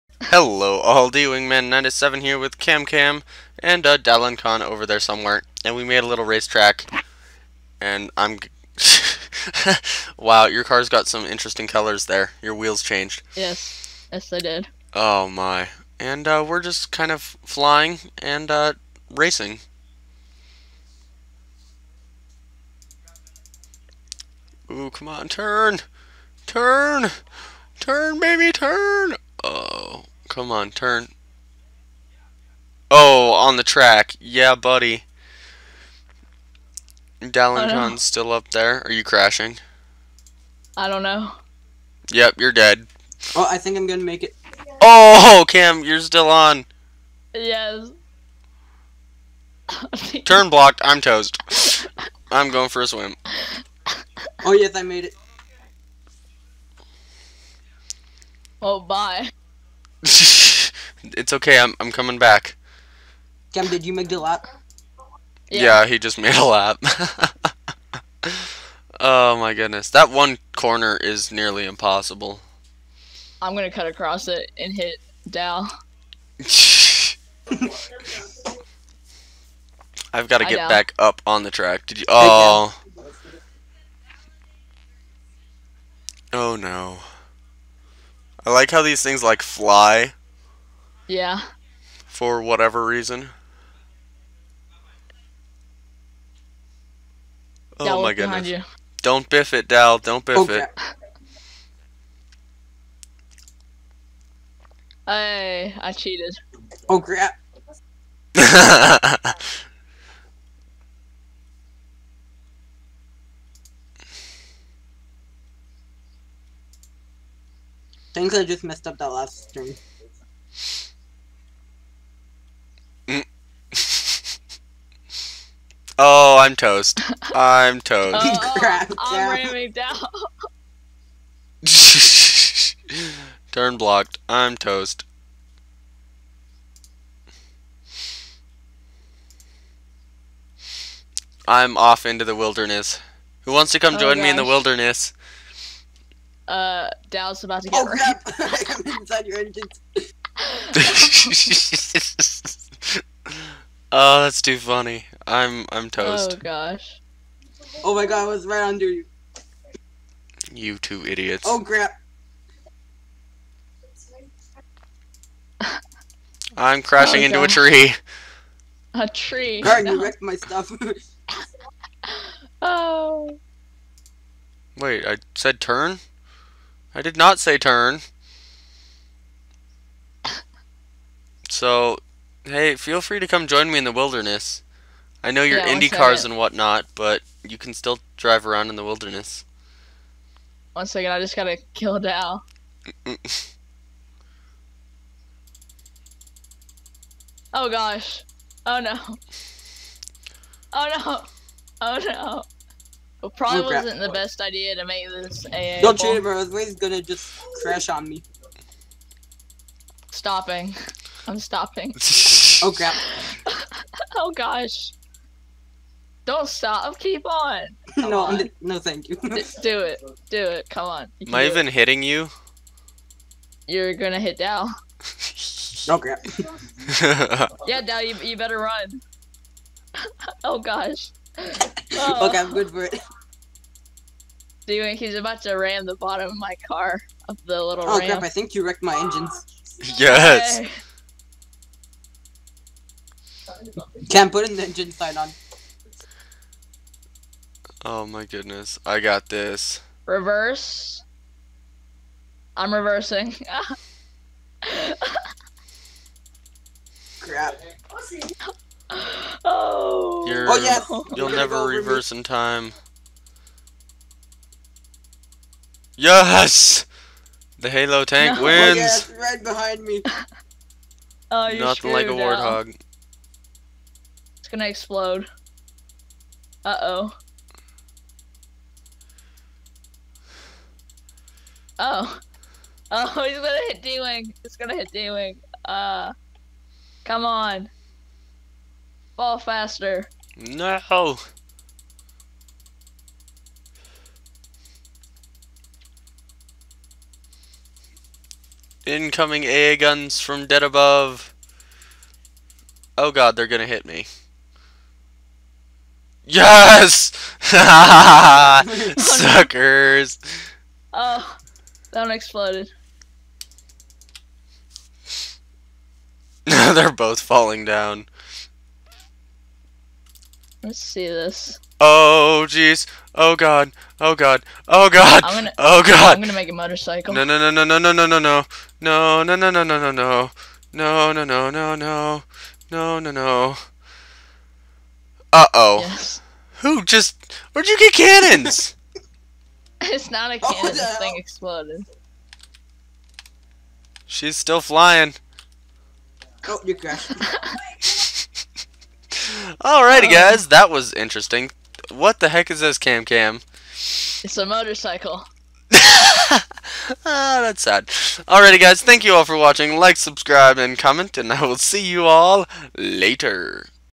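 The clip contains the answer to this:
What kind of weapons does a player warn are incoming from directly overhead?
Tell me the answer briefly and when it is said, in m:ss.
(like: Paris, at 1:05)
AA guns, at 4:59.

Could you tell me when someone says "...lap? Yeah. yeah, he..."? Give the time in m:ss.
1:04.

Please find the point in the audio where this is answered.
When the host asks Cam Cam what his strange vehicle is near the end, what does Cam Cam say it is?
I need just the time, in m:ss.
5:54.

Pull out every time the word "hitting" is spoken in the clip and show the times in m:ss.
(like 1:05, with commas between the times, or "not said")
3:41.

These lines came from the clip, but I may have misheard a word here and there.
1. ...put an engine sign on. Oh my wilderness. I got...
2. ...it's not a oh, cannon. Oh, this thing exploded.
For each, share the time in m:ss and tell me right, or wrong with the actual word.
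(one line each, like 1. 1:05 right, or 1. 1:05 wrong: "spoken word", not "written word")
1. 4:04 wrong: "goodness", not "wilderness"
2. 5:39 right.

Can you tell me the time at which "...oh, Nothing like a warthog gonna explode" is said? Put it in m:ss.
4:31.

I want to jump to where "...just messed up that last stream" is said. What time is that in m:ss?
1:58.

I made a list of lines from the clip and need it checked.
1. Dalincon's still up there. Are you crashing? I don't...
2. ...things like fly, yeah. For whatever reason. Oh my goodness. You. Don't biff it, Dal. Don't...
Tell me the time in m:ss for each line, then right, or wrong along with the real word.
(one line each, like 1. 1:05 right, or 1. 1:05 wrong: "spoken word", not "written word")
1. 0:37 right
2. 1:29 right.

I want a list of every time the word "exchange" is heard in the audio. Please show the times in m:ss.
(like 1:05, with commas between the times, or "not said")
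not said.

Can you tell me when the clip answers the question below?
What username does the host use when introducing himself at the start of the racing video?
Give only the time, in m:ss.
0:00.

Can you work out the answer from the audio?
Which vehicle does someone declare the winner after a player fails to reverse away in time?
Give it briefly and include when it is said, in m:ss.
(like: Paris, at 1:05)
The Halo tank, at 4:27.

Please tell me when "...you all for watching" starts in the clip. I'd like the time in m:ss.
5:59.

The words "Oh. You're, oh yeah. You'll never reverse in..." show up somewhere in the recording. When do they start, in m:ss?
4:19.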